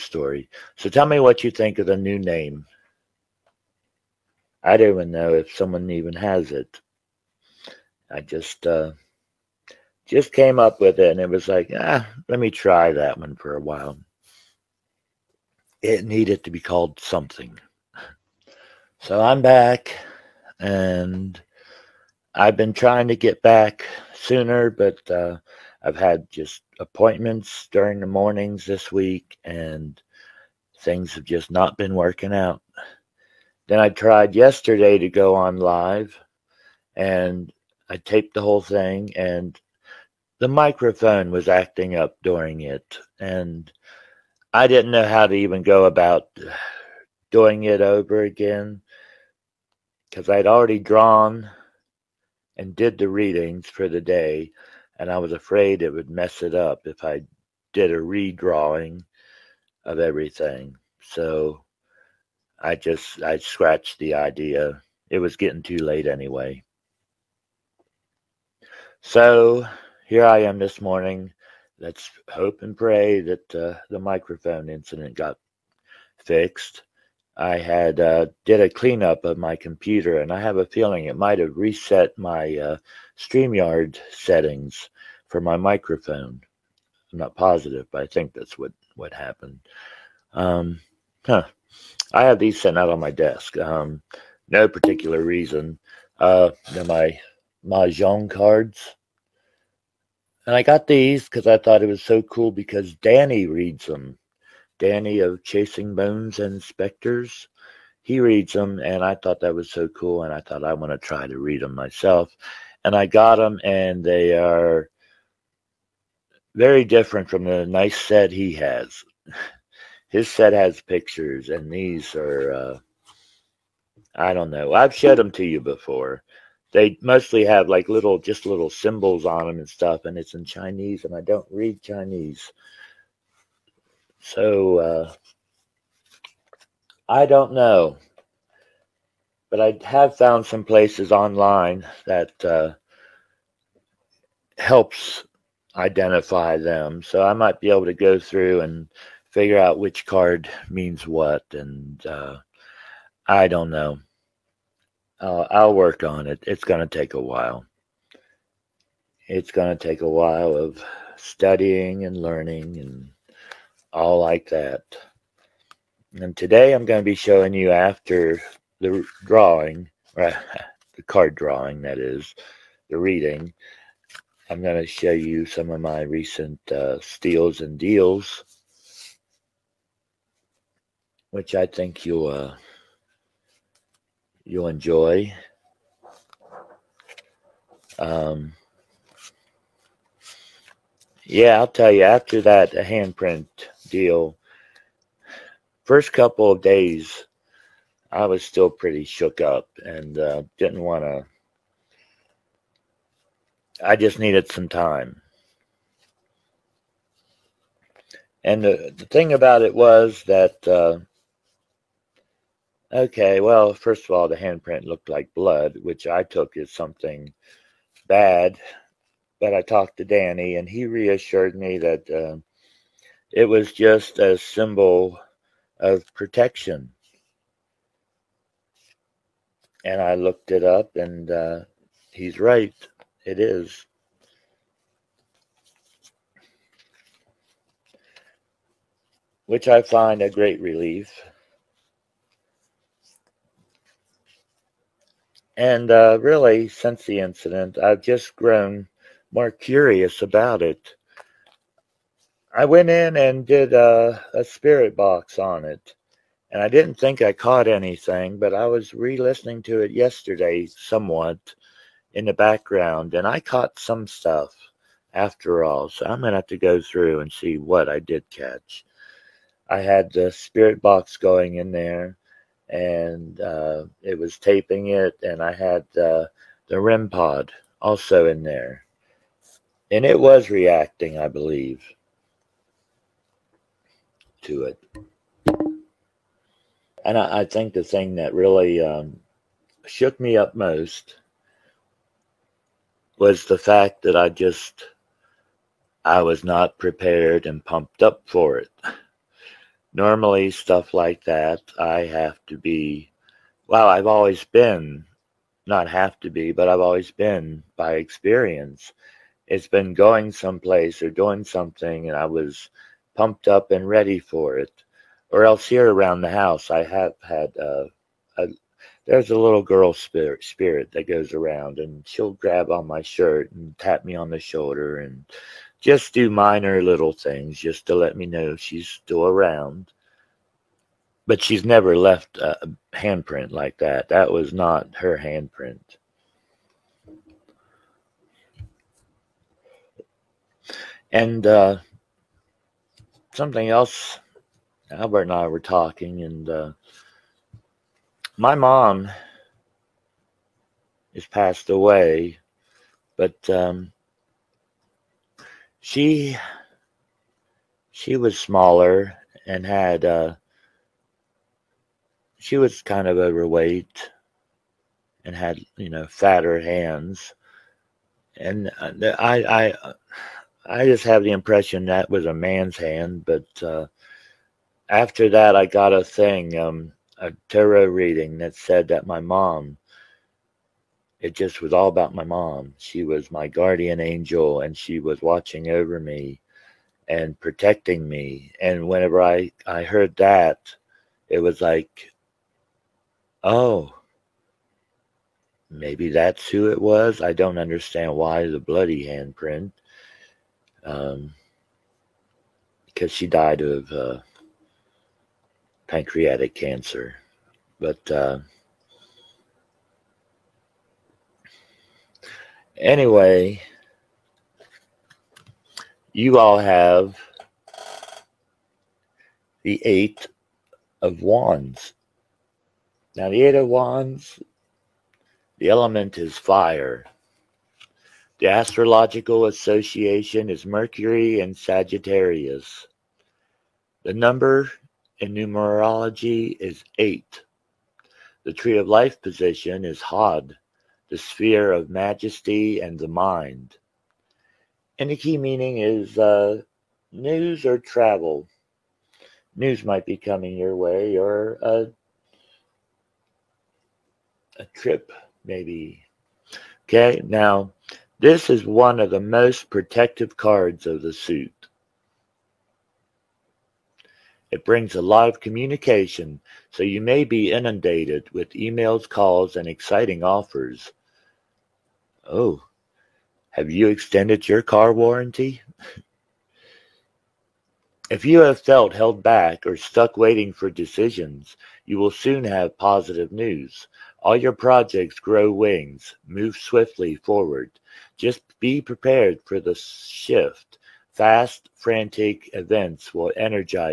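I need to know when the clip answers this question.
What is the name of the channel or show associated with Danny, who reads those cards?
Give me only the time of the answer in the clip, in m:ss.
1:45.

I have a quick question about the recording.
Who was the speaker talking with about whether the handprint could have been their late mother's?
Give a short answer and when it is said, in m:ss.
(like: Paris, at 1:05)
Albert, at 5:44.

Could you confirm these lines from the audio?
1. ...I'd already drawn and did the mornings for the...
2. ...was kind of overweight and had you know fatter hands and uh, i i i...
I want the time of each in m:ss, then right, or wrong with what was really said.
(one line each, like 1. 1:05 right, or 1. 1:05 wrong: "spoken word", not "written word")
1. 0:50 wrong: "readings", not "mornings"
2. 6:02 right.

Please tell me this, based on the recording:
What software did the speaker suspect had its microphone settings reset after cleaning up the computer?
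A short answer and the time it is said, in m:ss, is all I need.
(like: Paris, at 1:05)
Streamyard, at 1:23.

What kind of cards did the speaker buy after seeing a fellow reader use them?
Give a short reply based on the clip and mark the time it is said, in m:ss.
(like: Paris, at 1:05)
mahjong cards, at 1:37.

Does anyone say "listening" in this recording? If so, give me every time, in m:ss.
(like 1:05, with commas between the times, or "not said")
4:19.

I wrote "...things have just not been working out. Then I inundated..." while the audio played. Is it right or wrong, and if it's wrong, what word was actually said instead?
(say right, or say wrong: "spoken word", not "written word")
wrong: "tried", not "inundated".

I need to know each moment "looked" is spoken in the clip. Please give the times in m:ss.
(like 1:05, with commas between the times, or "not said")
3:34, 3:50.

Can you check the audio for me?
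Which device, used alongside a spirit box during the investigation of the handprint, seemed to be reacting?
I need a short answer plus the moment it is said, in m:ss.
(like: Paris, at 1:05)
REM pod, at 4:36.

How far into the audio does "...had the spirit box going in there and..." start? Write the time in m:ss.
4:29.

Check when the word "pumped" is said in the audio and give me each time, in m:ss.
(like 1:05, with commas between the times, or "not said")
4:57, 5:13.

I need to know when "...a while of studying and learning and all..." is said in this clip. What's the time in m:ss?
2:40.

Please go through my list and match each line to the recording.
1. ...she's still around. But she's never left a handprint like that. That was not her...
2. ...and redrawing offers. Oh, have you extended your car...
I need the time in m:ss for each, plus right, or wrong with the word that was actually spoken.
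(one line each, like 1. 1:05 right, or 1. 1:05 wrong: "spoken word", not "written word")
1. 5:28 right
2. 7:49 wrong: "exciting", not "redrawing".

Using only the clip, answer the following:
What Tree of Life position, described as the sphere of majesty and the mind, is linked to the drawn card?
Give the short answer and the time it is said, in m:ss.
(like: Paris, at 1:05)
Hod, at 7:20.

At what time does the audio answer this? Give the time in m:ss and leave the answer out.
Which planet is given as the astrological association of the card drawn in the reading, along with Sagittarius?
7:10.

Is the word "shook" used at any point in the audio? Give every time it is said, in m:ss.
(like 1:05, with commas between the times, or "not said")
3:19, 4:49.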